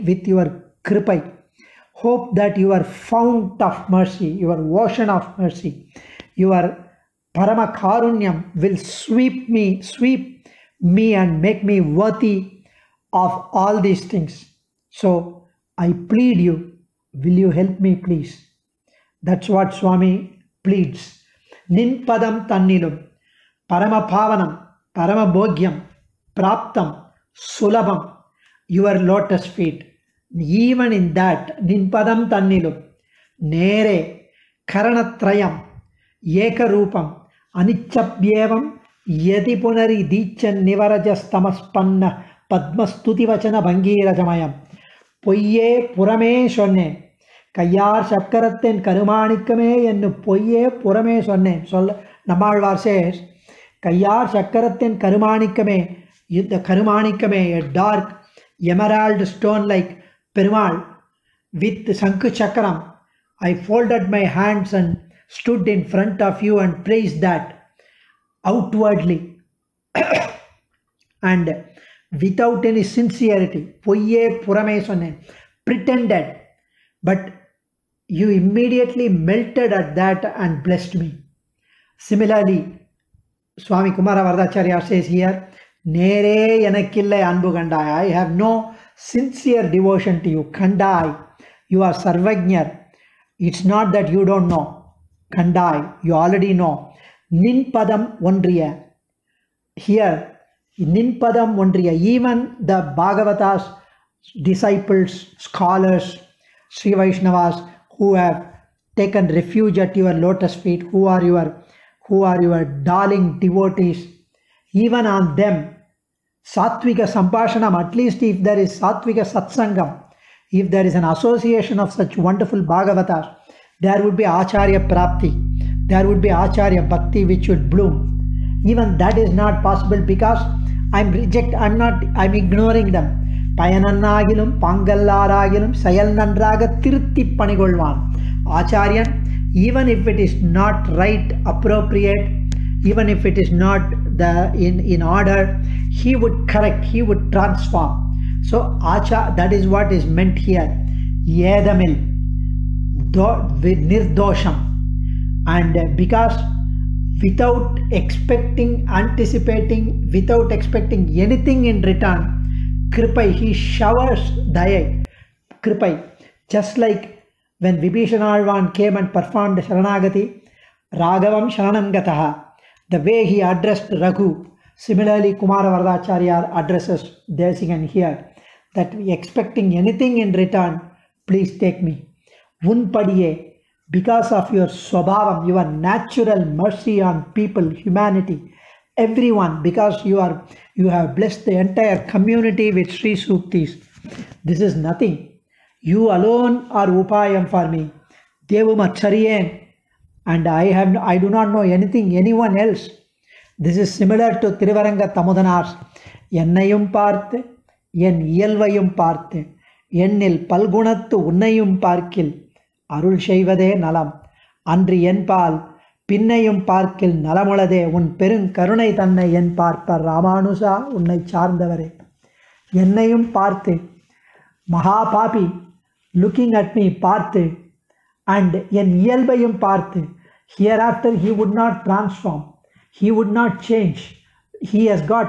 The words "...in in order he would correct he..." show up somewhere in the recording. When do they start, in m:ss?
2:24.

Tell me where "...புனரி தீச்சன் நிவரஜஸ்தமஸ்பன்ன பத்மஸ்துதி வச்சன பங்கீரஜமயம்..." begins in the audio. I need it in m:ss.
0:39.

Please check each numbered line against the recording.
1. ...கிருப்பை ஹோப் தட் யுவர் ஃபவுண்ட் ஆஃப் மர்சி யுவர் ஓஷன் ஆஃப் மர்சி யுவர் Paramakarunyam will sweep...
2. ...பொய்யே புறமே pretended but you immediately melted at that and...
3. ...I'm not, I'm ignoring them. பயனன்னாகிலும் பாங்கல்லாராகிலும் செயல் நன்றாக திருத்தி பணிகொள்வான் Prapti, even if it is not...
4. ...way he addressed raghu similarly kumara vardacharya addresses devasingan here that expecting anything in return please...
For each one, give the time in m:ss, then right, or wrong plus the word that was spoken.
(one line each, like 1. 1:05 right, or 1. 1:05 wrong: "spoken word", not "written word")
1. 0:00 right
2. 1:13 right
3. 2:11 wrong: "Acharya", not "Prapti"
4. 2:53 right.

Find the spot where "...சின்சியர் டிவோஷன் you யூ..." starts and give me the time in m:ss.
1:29.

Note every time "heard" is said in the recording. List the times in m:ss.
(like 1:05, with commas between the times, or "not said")
not said.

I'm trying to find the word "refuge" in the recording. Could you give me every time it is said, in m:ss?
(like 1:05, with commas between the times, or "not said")
1:49.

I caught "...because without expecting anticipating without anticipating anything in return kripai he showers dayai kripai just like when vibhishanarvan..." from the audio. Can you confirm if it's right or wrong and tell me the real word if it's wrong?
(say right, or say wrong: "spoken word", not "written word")
wrong: "expecting", not "anticipating".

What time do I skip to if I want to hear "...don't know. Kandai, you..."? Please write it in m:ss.
1:34.